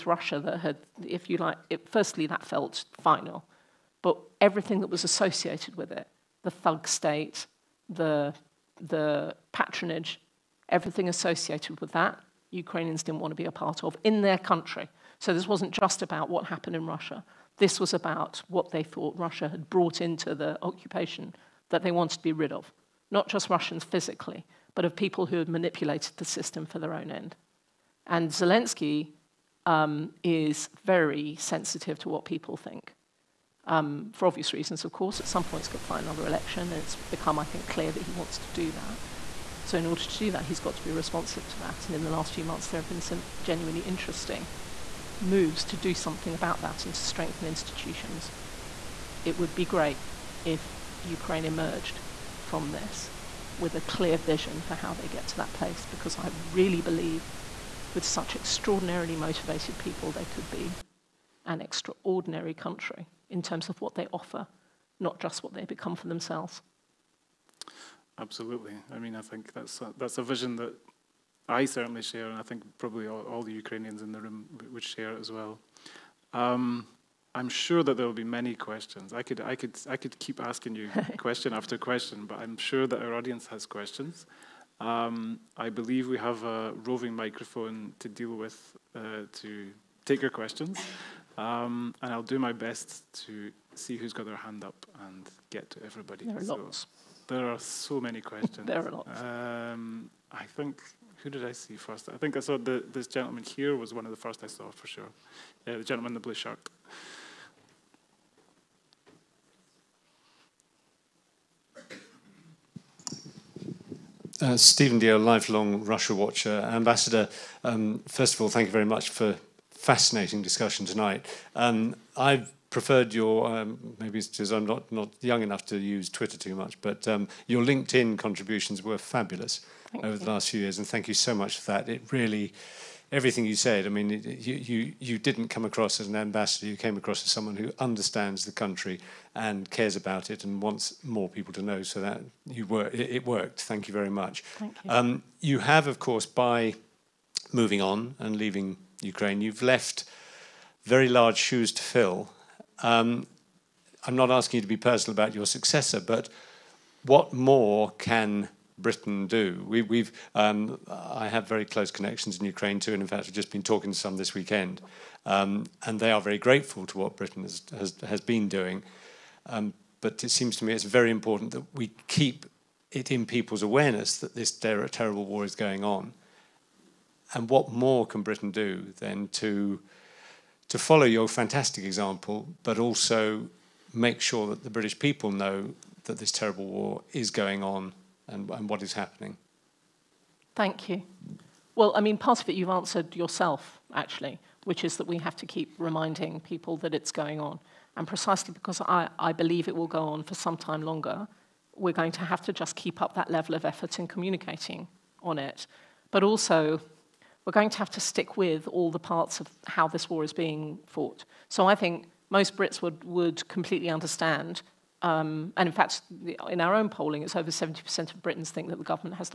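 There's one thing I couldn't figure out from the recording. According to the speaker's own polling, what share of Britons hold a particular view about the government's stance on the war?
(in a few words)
over 70%.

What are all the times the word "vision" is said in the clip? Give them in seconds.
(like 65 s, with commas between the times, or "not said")
54 s, 70 s.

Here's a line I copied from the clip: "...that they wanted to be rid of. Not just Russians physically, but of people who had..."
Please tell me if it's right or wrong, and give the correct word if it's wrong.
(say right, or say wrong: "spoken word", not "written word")
right.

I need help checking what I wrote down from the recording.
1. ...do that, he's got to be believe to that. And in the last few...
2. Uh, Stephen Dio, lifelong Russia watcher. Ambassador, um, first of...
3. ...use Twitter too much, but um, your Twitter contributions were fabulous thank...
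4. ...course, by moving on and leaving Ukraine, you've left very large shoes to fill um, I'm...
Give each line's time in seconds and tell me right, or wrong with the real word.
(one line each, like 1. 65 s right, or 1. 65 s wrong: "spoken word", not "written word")
1. 40 s wrong: "responsive", not "believe"
2. 114 s right
3. 125 s wrong: "LinkedIn", not "Twitter"
4. 145 s right.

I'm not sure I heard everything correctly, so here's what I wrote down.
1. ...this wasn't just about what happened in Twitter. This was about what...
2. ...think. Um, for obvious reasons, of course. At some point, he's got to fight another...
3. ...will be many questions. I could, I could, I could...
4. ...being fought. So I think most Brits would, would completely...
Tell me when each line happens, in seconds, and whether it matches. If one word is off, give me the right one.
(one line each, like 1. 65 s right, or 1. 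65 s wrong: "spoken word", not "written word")
1. 15 s wrong: "Russia", not "Twitter"
2. 32 s right
3. 78 s right
4. 210 s right.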